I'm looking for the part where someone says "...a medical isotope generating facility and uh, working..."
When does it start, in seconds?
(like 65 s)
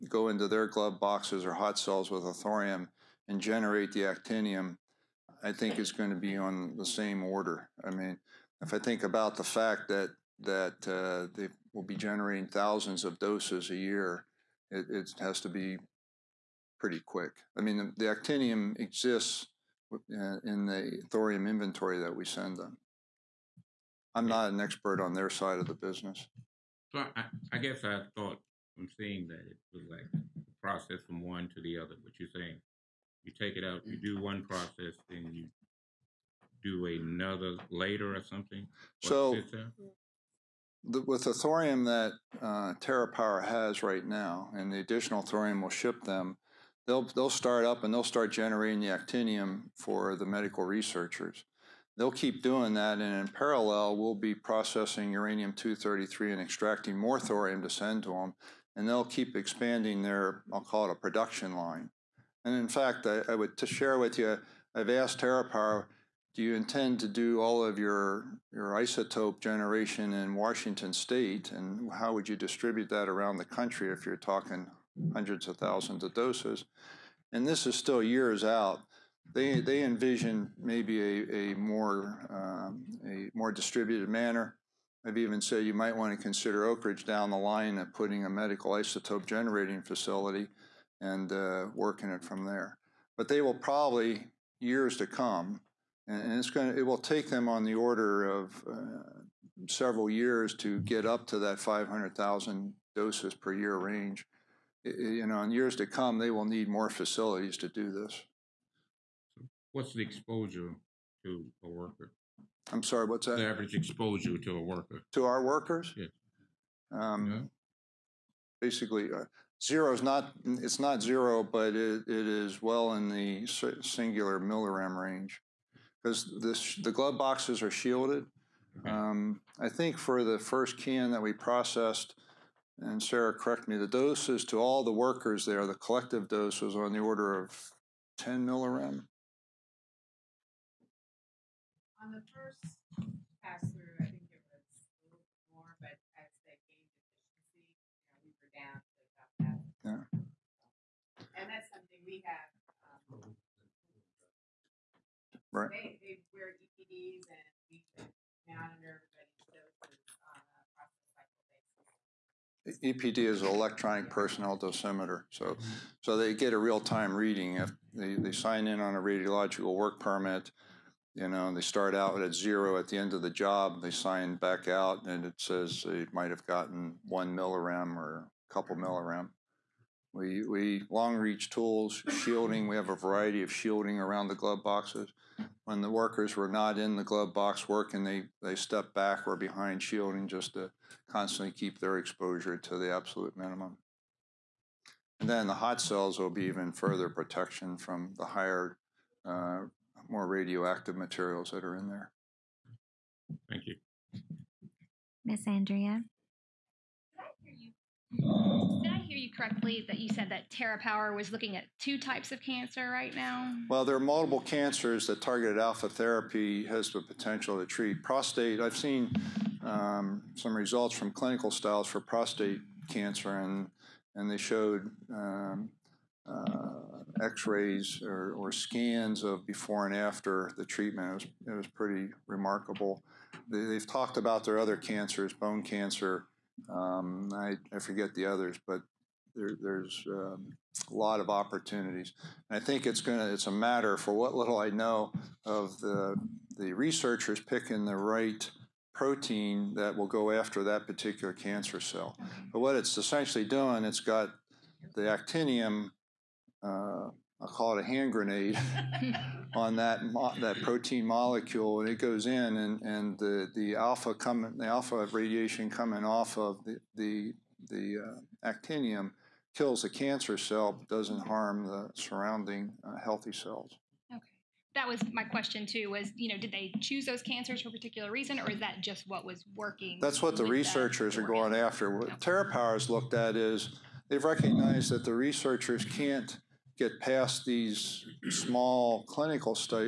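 88 s.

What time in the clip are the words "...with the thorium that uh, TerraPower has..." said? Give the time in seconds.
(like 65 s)
41 s.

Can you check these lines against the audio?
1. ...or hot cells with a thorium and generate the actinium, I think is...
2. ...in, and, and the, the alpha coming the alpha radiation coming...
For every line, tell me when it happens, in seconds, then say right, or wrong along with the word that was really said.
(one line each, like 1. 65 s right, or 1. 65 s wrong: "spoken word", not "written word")
1. 1 s right
2. 262 s right.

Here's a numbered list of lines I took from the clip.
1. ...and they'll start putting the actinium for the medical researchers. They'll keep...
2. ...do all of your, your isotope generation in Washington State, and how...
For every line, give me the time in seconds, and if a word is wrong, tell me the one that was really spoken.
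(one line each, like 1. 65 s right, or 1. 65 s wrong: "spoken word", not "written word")
1. 47 s wrong: "generating", not "putting"
2. 67 s right.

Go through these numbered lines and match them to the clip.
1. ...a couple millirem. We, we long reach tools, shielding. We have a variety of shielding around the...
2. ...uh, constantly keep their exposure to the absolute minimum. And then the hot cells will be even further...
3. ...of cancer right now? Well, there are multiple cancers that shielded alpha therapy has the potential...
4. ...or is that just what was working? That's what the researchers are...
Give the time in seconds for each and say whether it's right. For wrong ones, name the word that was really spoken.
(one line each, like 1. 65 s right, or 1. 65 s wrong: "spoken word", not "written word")
1. 178 s right
2. 190 s right
3. 212 s wrong: "targeted", not "shielded"
4. 278 s right.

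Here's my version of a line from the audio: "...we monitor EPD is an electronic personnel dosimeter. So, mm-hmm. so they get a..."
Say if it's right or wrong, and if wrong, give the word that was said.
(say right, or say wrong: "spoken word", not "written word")
right.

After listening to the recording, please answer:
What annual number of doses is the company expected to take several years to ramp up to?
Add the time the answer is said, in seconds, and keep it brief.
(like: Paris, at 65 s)
500,000, at 101 s.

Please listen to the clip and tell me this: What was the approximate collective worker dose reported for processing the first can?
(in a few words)
10 millirem.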